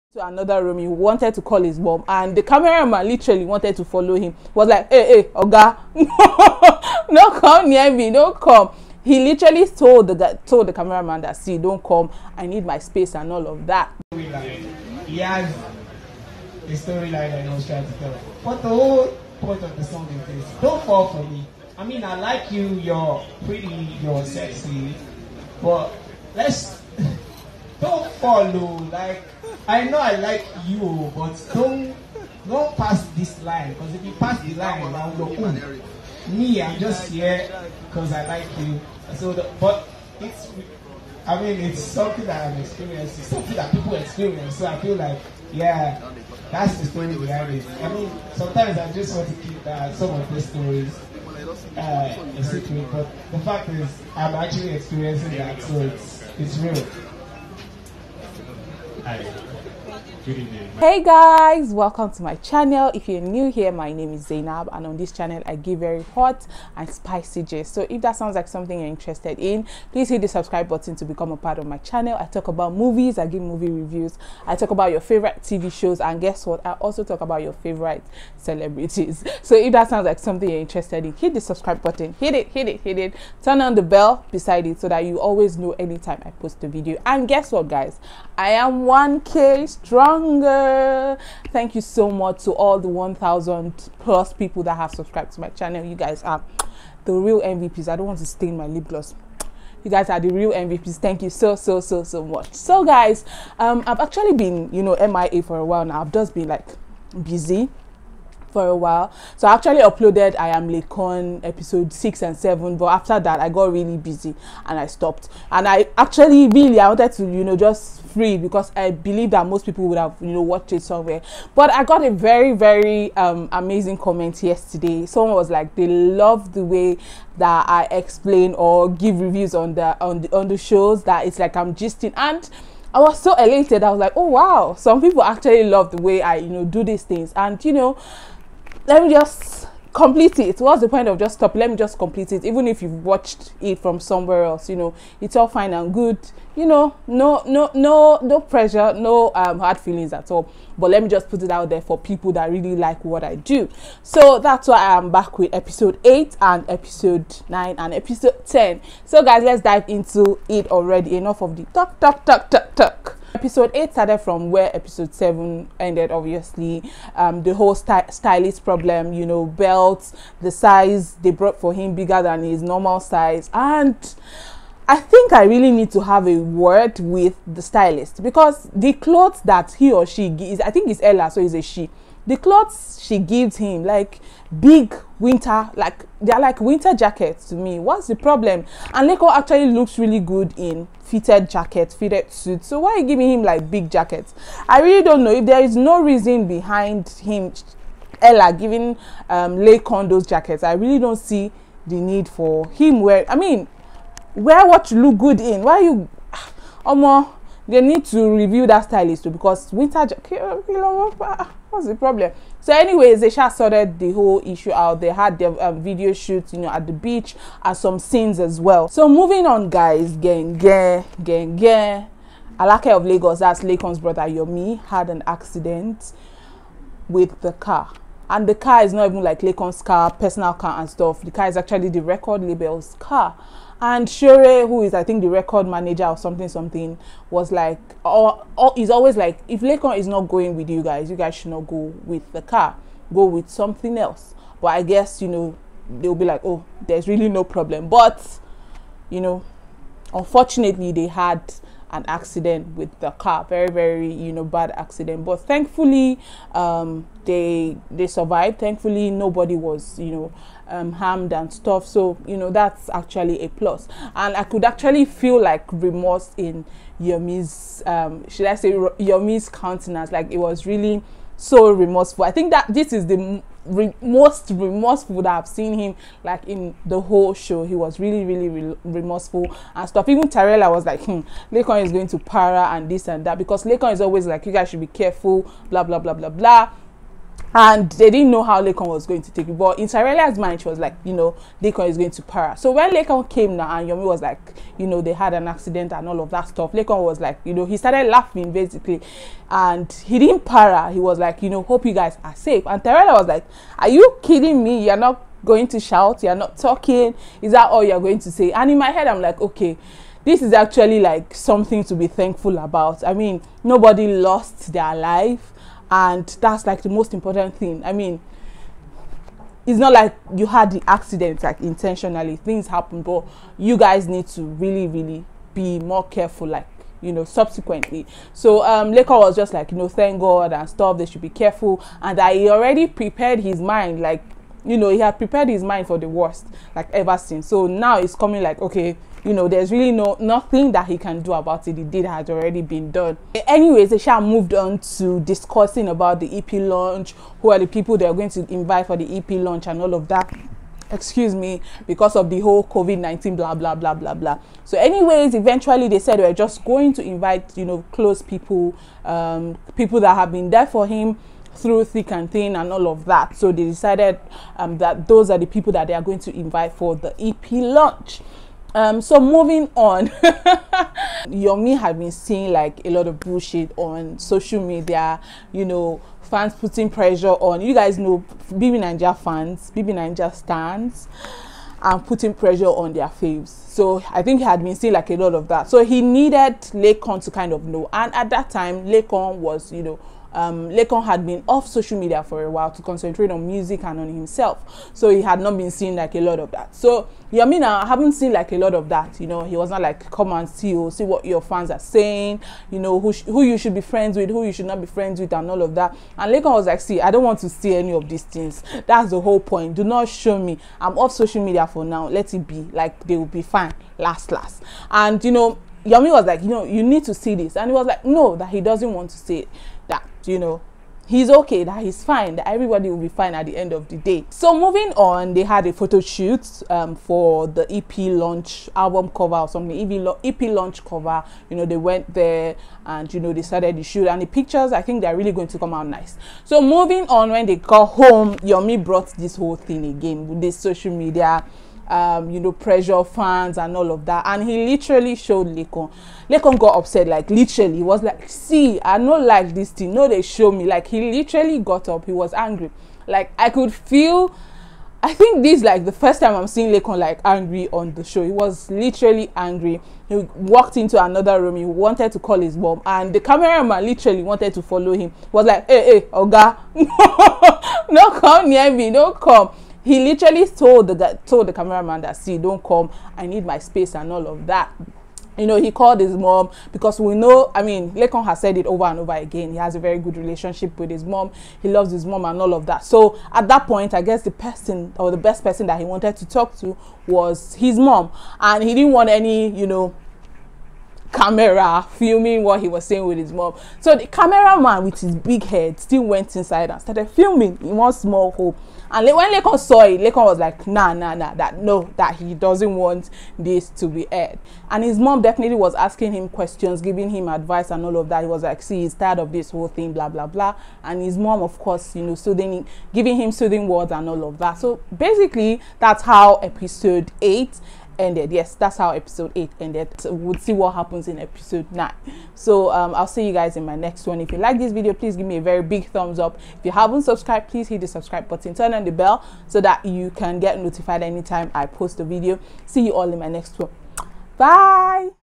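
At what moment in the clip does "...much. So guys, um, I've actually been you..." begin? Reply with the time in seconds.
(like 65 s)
102 s.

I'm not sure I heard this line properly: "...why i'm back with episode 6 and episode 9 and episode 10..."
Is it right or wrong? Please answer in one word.
wrong.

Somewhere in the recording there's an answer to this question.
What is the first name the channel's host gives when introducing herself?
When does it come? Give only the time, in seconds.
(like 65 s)
64 s.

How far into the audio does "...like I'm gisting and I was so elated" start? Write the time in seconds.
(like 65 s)
131 s.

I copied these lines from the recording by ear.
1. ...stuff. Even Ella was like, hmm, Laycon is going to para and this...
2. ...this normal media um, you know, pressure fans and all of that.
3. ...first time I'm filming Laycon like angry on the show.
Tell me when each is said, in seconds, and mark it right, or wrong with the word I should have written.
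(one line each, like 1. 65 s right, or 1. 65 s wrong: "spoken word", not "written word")
1. 279 s wrong: "Tarella", not "Ella"
2. 440 s wrong: "social", not "normal"
3. 455 s wrong: "seeing", not "filming".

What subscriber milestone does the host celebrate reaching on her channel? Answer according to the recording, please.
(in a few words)
1k.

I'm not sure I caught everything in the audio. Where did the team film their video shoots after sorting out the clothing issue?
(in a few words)
the beach.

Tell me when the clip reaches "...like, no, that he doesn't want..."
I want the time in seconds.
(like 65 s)
417 s.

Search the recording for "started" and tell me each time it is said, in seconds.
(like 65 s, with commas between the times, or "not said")
163 s, 297 s, 433 s, 496 s.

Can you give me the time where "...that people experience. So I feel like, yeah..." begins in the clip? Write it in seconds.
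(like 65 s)
43 s.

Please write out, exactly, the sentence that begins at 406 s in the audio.
And Laycon was like, see, I don't want to see any of these things.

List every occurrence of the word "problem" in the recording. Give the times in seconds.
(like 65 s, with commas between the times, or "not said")
168 s, 188 s, 211 s, 247 s.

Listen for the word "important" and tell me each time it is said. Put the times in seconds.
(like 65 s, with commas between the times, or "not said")
317 s.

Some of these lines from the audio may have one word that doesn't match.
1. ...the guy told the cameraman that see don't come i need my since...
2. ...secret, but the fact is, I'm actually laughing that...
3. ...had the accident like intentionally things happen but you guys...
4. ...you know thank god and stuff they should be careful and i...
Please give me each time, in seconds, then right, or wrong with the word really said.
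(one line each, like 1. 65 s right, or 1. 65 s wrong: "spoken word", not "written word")
1. 10 s wrong: "space", not "since"
2. 52 s wrong: "experiencing", not "laughing"
3. 320 s right
4. 329 s right.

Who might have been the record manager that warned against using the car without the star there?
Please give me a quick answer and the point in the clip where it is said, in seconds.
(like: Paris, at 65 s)
Shure, at 234 s.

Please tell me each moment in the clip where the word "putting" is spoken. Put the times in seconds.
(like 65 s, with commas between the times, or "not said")
376 s, 382 s.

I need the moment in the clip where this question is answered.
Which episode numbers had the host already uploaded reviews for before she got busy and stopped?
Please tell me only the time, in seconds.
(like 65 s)
111 s.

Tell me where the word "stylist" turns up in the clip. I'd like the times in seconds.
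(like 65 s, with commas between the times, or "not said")
168 s, 177 s, 208 s.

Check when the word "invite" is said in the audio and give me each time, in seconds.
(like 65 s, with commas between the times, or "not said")
348 s, 357 s, 366 s.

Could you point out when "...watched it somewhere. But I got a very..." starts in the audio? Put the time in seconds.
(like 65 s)
120 s.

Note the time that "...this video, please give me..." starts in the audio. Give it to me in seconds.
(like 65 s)
524 s.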